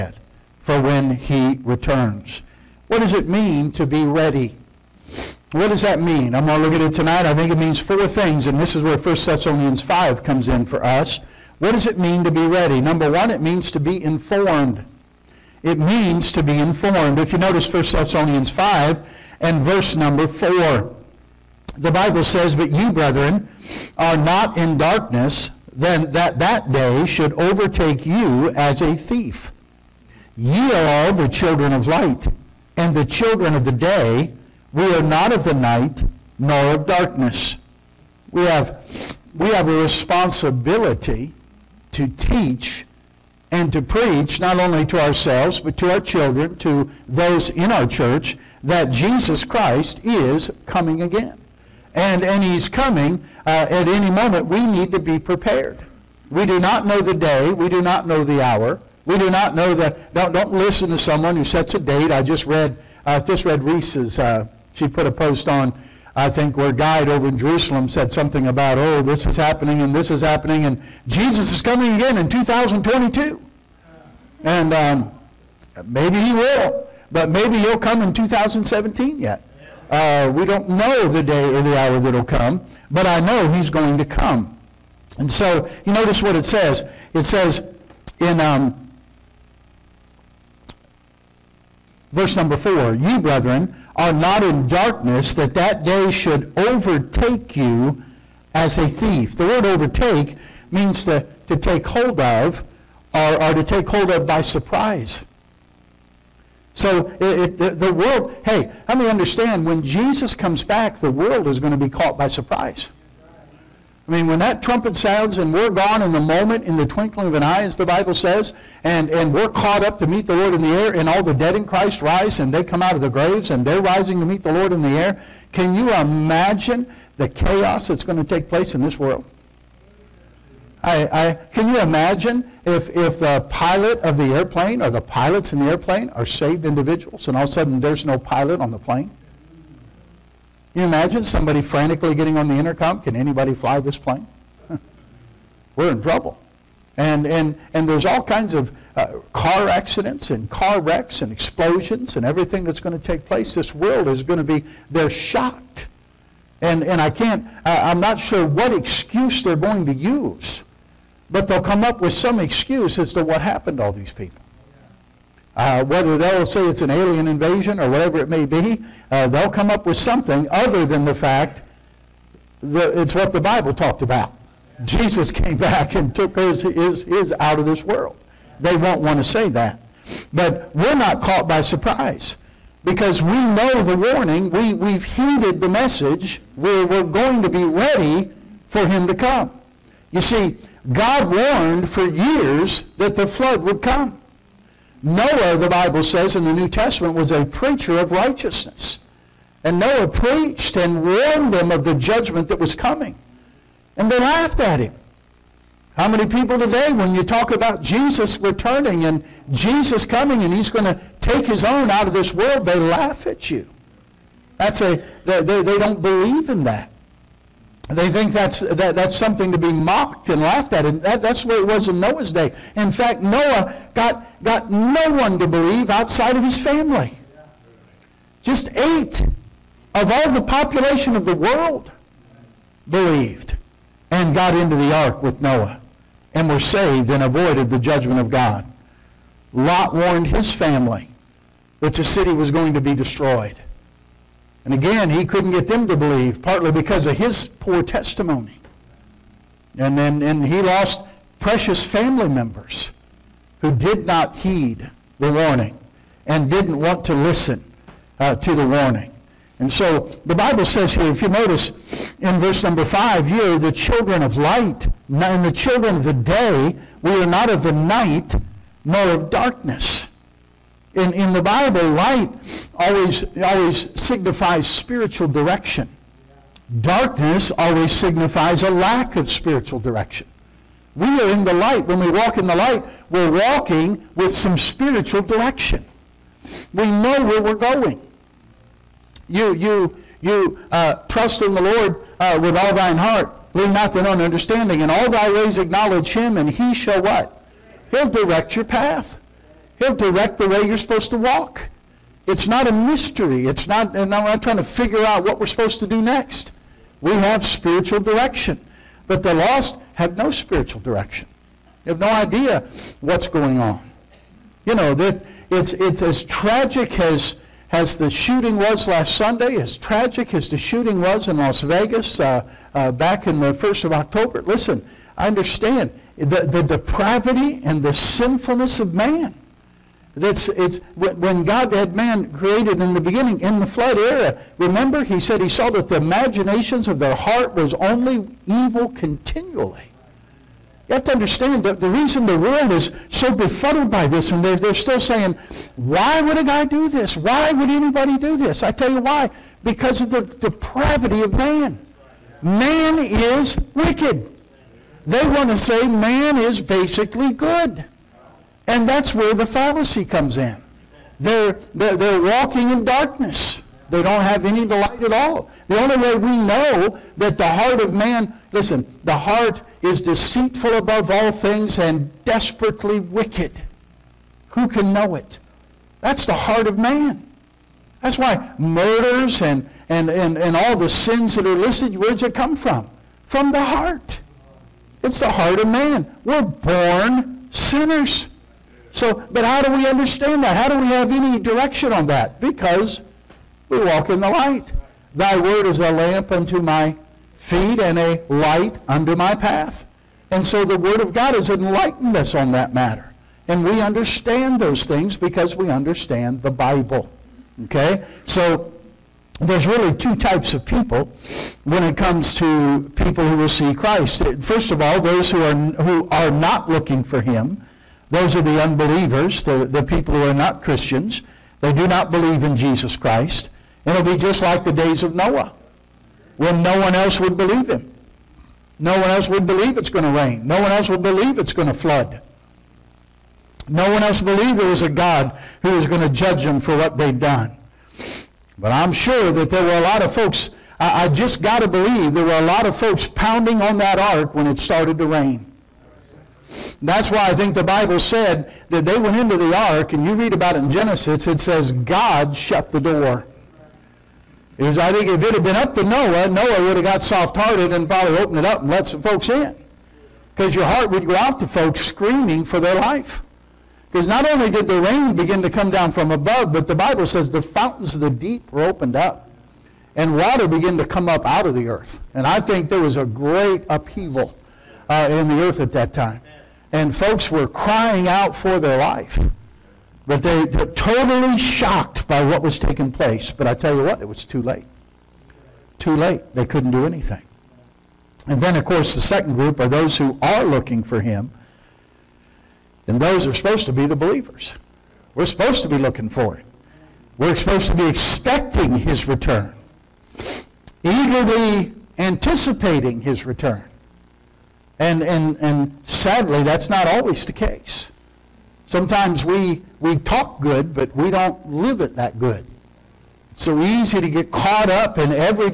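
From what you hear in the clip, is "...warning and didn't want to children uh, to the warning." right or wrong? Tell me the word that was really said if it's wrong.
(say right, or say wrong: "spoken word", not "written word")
wrong: "listen", not "children".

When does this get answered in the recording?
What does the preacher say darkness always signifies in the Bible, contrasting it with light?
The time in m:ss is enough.
4:38.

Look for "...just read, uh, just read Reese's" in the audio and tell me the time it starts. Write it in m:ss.
1:02.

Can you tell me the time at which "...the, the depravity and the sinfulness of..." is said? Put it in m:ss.
5:26.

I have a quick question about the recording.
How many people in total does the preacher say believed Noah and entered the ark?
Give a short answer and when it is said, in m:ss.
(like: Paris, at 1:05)
8, at 3:48.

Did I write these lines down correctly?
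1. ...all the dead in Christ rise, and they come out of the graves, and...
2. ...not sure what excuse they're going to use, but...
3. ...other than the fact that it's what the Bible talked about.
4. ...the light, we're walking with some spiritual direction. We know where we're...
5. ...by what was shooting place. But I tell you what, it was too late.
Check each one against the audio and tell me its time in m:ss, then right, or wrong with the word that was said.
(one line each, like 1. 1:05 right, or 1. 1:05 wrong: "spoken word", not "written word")
1. 2:01 right
2. 2:37 right
3. 2:50 right
4. 4:42 right
5. 8:02 wrong: "taking", not "shooting".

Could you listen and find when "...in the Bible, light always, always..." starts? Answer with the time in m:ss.
4:31.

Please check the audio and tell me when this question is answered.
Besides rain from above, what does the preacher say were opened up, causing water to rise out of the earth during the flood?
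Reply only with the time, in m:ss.
7:47.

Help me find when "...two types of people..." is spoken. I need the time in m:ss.
6:49.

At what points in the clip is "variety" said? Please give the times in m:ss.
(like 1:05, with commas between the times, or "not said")
not said.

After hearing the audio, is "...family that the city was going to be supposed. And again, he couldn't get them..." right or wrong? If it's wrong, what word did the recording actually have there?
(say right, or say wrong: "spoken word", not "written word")
wrong: "destroyed", not "supposed".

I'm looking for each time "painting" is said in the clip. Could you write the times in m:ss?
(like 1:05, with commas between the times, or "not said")
not said.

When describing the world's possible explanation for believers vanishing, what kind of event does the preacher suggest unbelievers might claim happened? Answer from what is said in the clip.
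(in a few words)
alien invasion.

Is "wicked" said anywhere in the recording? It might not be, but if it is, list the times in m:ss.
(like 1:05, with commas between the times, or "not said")
5:53, 6:13.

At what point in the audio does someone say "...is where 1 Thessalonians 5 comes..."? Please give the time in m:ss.
0:08.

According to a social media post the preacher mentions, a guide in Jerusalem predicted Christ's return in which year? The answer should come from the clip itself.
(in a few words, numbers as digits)
2022.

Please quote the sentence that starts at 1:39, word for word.
The word overtake means to, to take hold of or, or to take hold of by surprise.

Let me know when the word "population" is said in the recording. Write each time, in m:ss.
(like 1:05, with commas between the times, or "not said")
3:50.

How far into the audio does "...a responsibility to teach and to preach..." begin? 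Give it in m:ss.
0:39.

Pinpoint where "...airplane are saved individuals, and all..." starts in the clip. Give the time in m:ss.
2:15.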